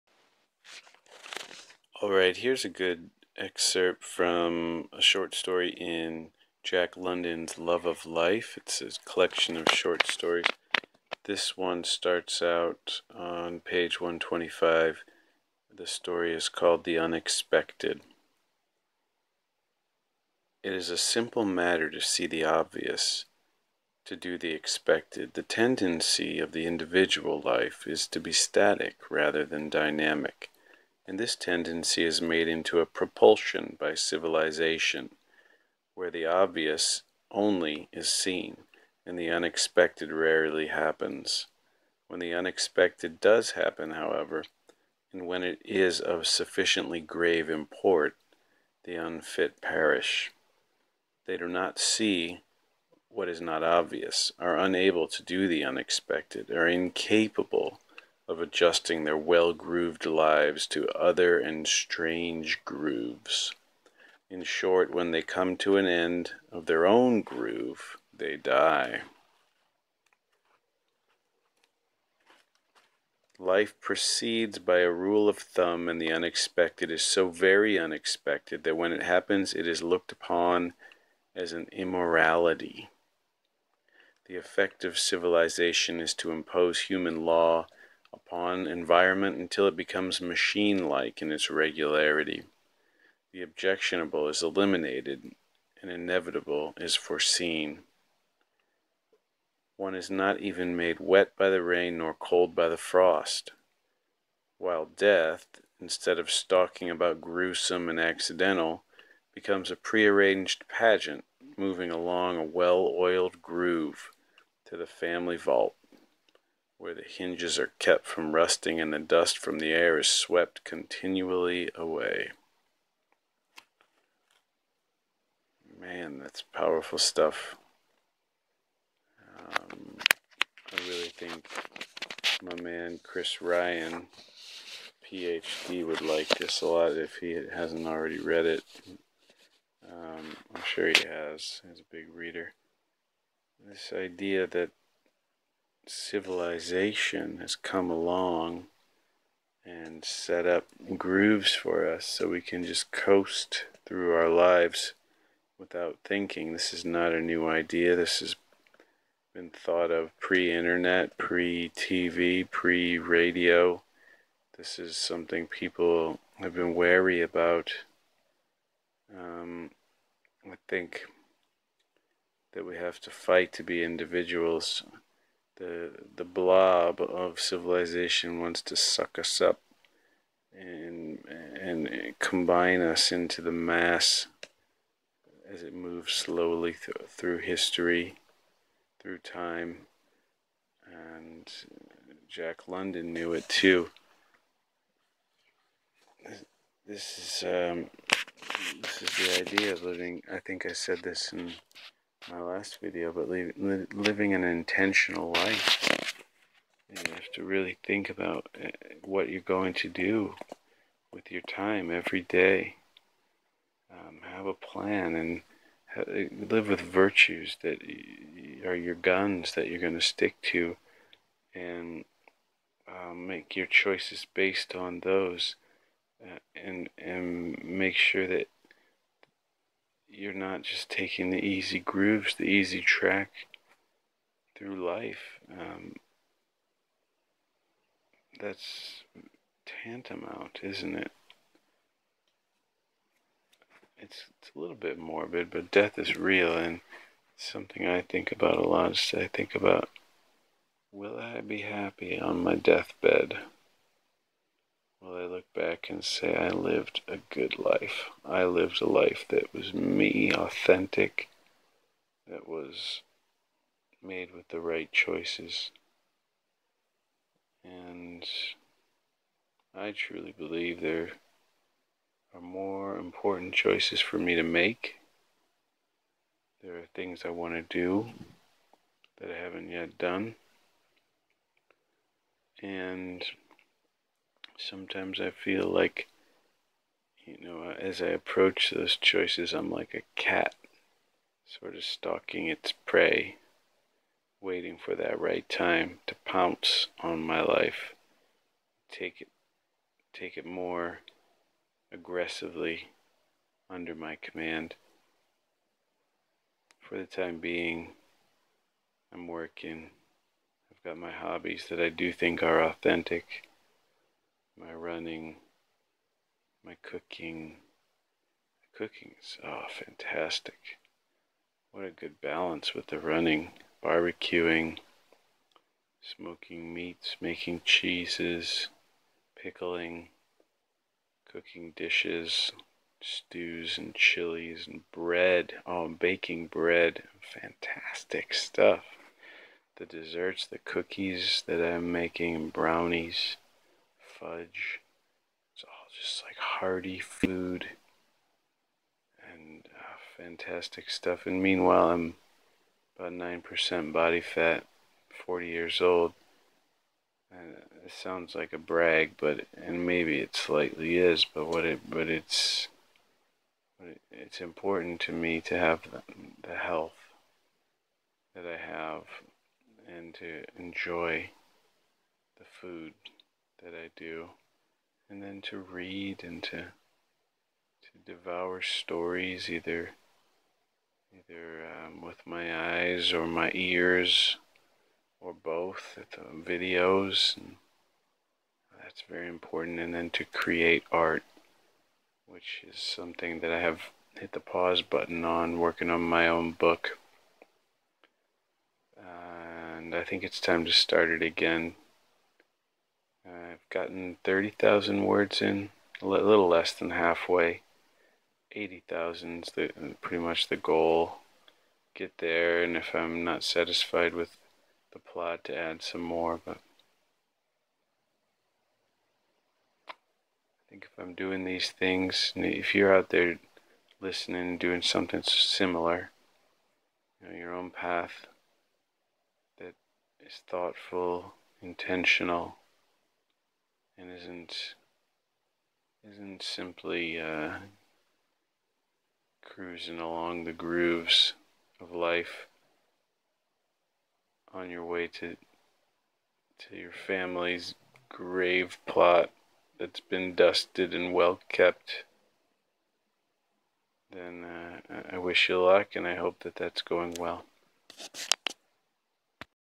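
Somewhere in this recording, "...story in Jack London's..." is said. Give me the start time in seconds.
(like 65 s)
5 s.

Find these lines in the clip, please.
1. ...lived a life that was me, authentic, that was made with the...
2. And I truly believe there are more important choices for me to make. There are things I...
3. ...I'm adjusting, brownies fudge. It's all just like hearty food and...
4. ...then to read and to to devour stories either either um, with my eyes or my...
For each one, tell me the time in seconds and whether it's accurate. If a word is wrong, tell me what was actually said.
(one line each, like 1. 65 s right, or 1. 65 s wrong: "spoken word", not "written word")
1. 258 s right
2. 267 s right
3. 341 s wrong: "making", not "adjusting"
4. 375 s right.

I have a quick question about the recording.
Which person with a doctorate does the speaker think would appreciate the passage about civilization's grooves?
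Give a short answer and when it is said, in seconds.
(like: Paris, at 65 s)
Chris Ryan, at 133 s.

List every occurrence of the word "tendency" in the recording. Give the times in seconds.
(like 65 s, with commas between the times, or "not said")
25 s, 31 s.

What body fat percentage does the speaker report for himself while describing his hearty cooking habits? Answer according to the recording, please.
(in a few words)
9%.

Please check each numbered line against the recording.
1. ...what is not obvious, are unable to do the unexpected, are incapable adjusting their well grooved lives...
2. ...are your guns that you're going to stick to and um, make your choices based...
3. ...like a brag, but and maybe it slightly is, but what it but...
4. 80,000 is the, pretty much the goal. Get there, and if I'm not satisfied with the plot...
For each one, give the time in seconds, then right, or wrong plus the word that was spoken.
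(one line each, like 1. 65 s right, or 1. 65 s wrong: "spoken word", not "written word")
1. 53 s right
2. 218 s right
3. 358 s right
4. 408 s right.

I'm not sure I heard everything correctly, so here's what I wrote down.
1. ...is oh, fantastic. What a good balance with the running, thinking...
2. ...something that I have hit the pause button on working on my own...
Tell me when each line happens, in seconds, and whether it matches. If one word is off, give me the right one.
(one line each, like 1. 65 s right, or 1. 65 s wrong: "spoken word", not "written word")
1. 319 s wrong: "barbecuing", not "thinking"
2. 392 s right.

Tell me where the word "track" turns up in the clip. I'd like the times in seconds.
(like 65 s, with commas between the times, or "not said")
232 s.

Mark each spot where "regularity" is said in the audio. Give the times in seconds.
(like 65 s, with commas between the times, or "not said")
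91 s.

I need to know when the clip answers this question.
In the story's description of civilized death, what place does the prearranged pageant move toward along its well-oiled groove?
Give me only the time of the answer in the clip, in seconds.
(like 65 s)
114 s.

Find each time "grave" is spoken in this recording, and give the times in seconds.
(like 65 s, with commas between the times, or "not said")
46 s, 448 s.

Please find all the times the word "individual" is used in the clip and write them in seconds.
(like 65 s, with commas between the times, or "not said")
26 s, 173 s.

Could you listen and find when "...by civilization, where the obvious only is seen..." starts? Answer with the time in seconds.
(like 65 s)
33 s.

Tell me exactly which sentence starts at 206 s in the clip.
You have to really think about uh, what you're going to do with your time every day.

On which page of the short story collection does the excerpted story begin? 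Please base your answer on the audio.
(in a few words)
125.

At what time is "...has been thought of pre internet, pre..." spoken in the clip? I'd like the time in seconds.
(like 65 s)
158 s.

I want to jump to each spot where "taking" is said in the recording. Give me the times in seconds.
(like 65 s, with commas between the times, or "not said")
230 s.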